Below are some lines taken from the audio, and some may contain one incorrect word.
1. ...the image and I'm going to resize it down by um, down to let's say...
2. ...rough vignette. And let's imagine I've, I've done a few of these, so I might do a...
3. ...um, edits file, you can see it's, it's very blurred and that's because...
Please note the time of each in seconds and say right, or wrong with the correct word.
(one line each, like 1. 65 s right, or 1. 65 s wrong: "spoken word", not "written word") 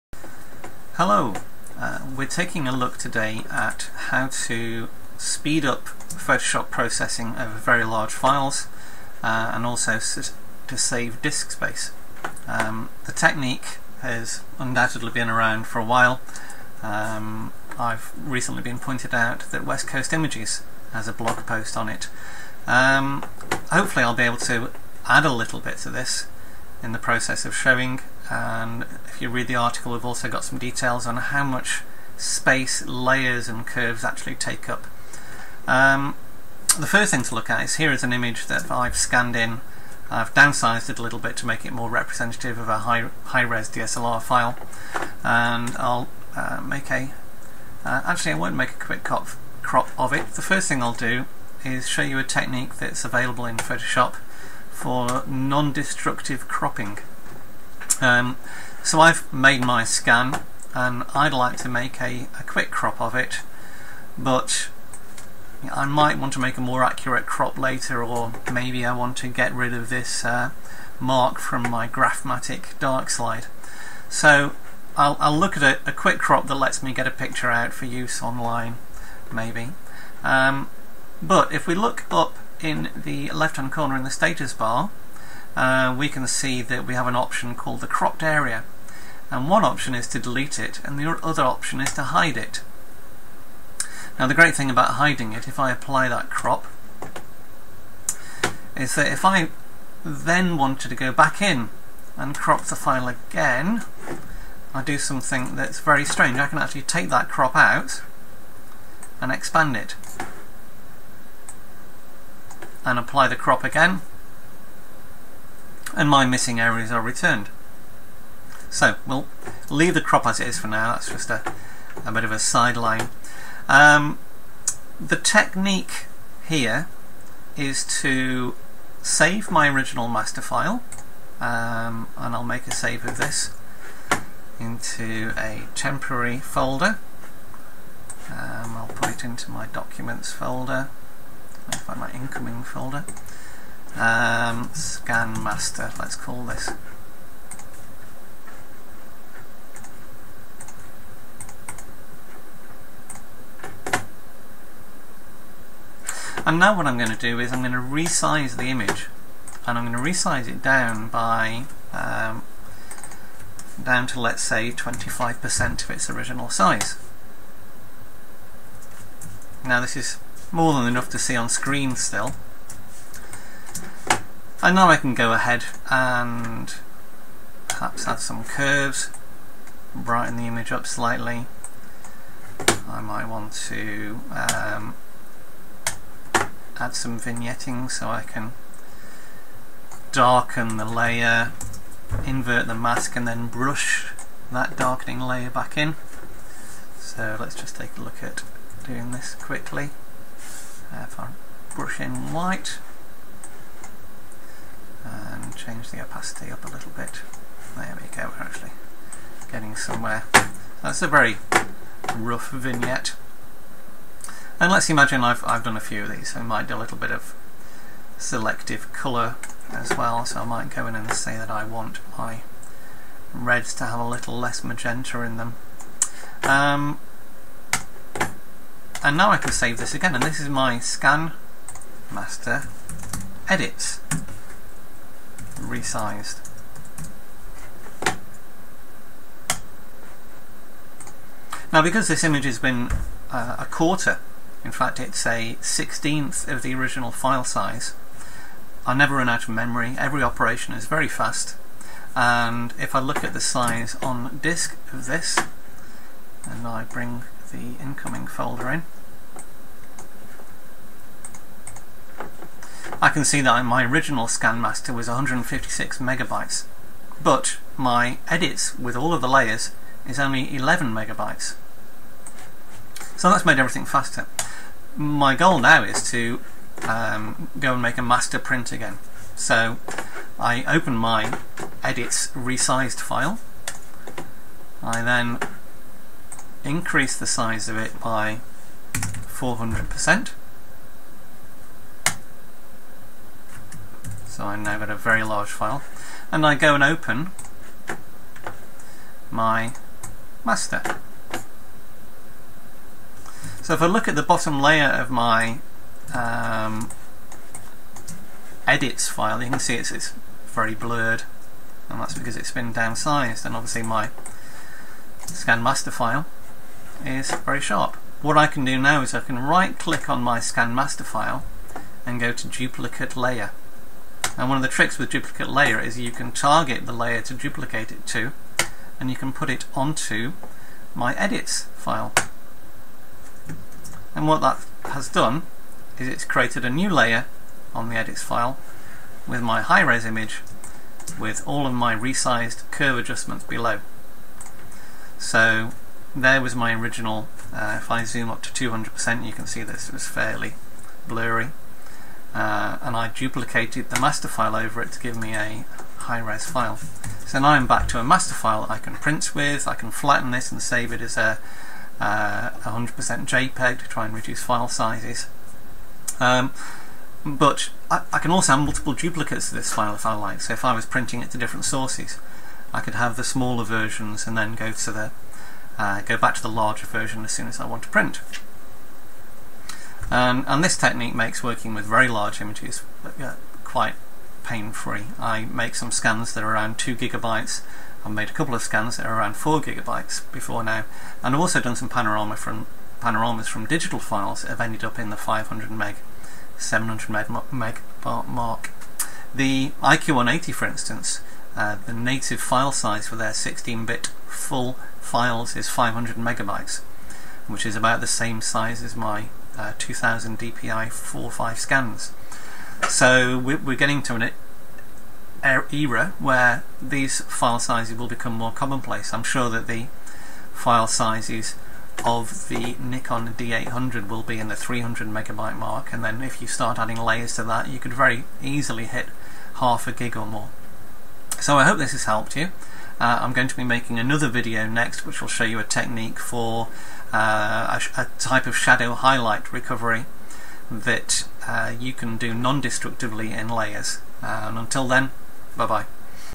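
1. 158 s right
2. 212 s right
3. 306 s right.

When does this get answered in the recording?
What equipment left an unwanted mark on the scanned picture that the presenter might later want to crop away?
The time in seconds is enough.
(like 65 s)
71 s.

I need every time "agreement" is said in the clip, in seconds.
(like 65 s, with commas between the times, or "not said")
not said.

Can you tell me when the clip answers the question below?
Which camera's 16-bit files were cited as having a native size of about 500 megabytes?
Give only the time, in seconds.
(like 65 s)
399 s.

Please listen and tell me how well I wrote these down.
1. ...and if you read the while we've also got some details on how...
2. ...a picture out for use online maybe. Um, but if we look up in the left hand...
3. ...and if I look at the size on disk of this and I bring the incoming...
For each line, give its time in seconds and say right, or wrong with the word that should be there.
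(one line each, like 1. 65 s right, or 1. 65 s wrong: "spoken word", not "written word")
1. 28 s wrong: "article", not "while"
2. 77 s right
3. 252 s right.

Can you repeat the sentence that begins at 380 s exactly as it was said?
And, um, and this technique makes working with very large images uh, quite pain-free.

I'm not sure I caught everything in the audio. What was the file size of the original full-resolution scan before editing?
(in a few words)
156 megabytes.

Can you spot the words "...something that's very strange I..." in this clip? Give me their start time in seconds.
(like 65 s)
104 s.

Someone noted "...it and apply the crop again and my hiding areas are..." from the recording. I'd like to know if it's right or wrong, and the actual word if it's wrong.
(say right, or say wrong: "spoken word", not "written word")
wrong: "missing", not "hiding".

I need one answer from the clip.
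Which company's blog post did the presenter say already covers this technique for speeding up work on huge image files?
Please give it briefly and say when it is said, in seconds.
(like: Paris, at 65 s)
West Coast Images, at 19 s.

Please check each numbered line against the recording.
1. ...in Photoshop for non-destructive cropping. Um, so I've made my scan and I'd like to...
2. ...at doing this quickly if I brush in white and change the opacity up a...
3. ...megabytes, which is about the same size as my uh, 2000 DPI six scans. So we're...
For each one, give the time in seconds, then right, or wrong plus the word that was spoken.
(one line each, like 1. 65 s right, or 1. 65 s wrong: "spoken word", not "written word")
1. 53 s right
2. 198 s right
3. 406 s wrong: "five", not "six".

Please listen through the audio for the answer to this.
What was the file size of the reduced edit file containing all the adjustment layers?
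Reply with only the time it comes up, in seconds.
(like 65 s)
270 s.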